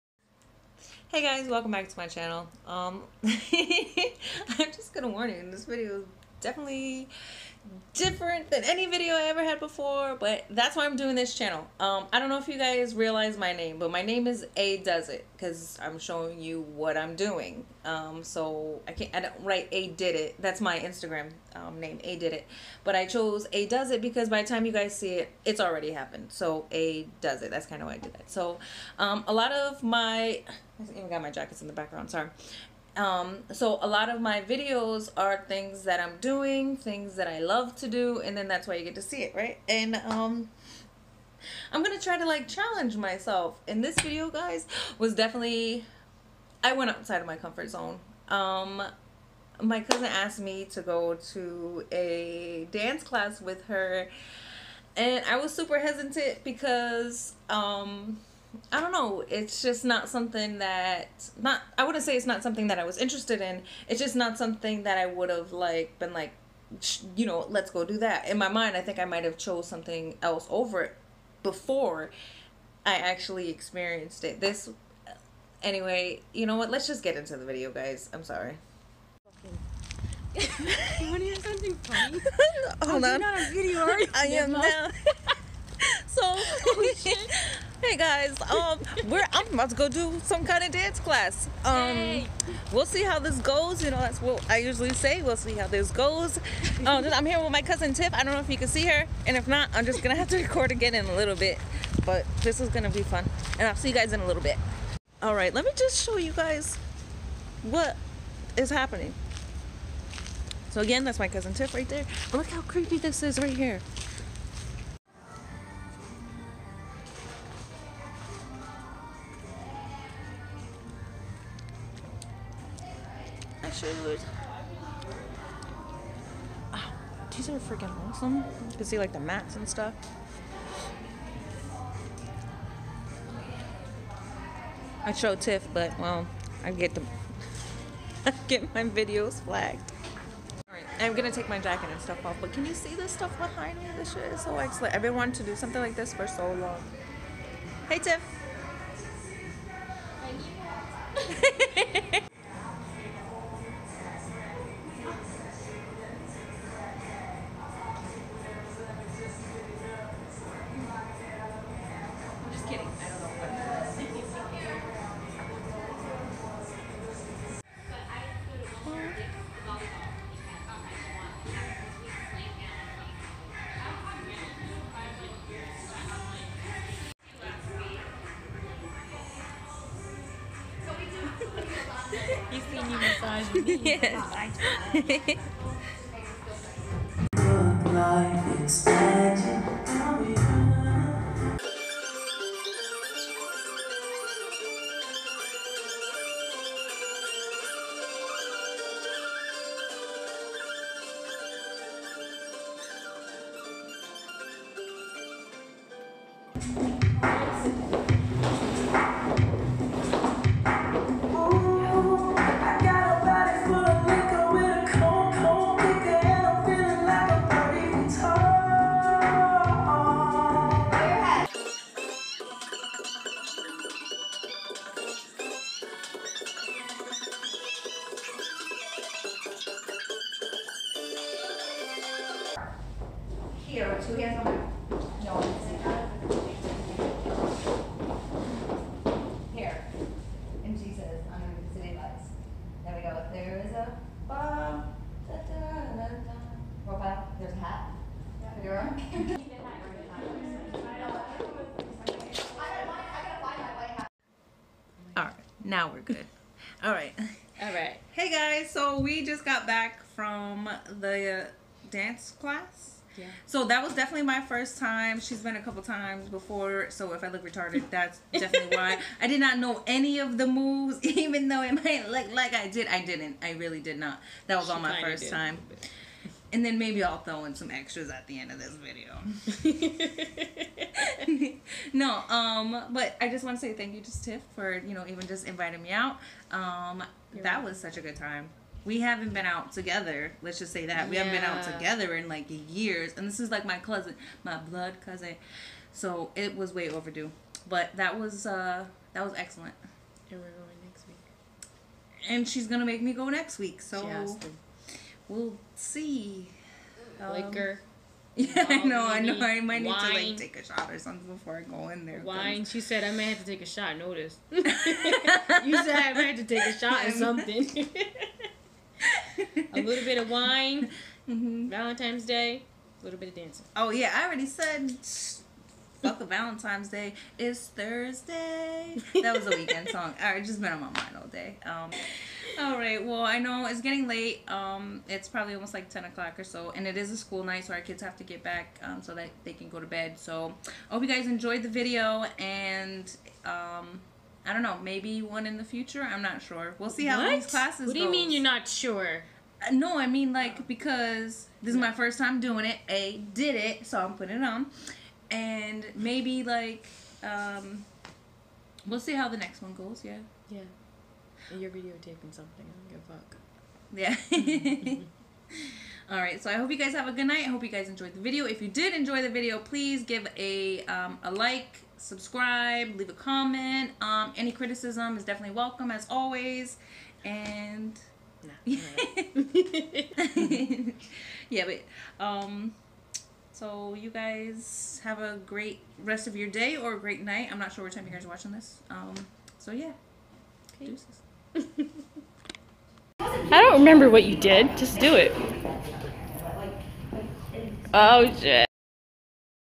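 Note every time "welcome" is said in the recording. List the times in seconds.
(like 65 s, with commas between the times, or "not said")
1 s, 375 s.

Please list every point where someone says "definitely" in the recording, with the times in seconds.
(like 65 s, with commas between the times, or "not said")
6 s, 45 s, 263 s, 268 s, 375 s.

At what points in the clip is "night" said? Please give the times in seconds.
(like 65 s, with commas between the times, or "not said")
337 s, 367 s, 387 s.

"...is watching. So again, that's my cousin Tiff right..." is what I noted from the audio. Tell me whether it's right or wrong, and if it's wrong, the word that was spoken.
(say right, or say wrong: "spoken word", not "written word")
wrong: "happening", not "watching".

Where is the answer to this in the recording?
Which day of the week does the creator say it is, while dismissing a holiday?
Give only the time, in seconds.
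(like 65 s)
327 s.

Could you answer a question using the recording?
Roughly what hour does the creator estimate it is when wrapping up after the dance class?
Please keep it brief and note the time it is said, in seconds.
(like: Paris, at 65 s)
10 o'clock, at 335 s.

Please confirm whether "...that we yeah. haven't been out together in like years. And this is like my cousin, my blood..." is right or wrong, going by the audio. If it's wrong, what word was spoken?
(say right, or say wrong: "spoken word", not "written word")
right.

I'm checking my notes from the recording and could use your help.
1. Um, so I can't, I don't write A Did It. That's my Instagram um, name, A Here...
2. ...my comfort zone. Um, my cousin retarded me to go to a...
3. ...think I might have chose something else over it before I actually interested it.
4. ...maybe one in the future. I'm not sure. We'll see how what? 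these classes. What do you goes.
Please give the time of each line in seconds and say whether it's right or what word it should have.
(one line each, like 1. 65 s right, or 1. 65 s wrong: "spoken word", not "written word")
1. 17 s wrong: "Did", not "Here"
2. 47 s wrong: "asked", not "retarded"
3. 68 s wrong: "experienced", not "interested"
4. 344 s right.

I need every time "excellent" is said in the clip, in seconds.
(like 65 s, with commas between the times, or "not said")
144 s, 299 s.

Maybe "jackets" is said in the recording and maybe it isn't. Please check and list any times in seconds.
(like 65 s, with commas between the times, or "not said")
31 s, 141 s.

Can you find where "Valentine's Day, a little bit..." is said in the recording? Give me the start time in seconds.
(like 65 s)
321 s.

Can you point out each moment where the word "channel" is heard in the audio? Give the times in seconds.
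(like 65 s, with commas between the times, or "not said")
2 s, 11 s.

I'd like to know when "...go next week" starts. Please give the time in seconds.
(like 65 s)
303 s.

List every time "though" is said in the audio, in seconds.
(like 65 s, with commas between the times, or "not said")
271 s.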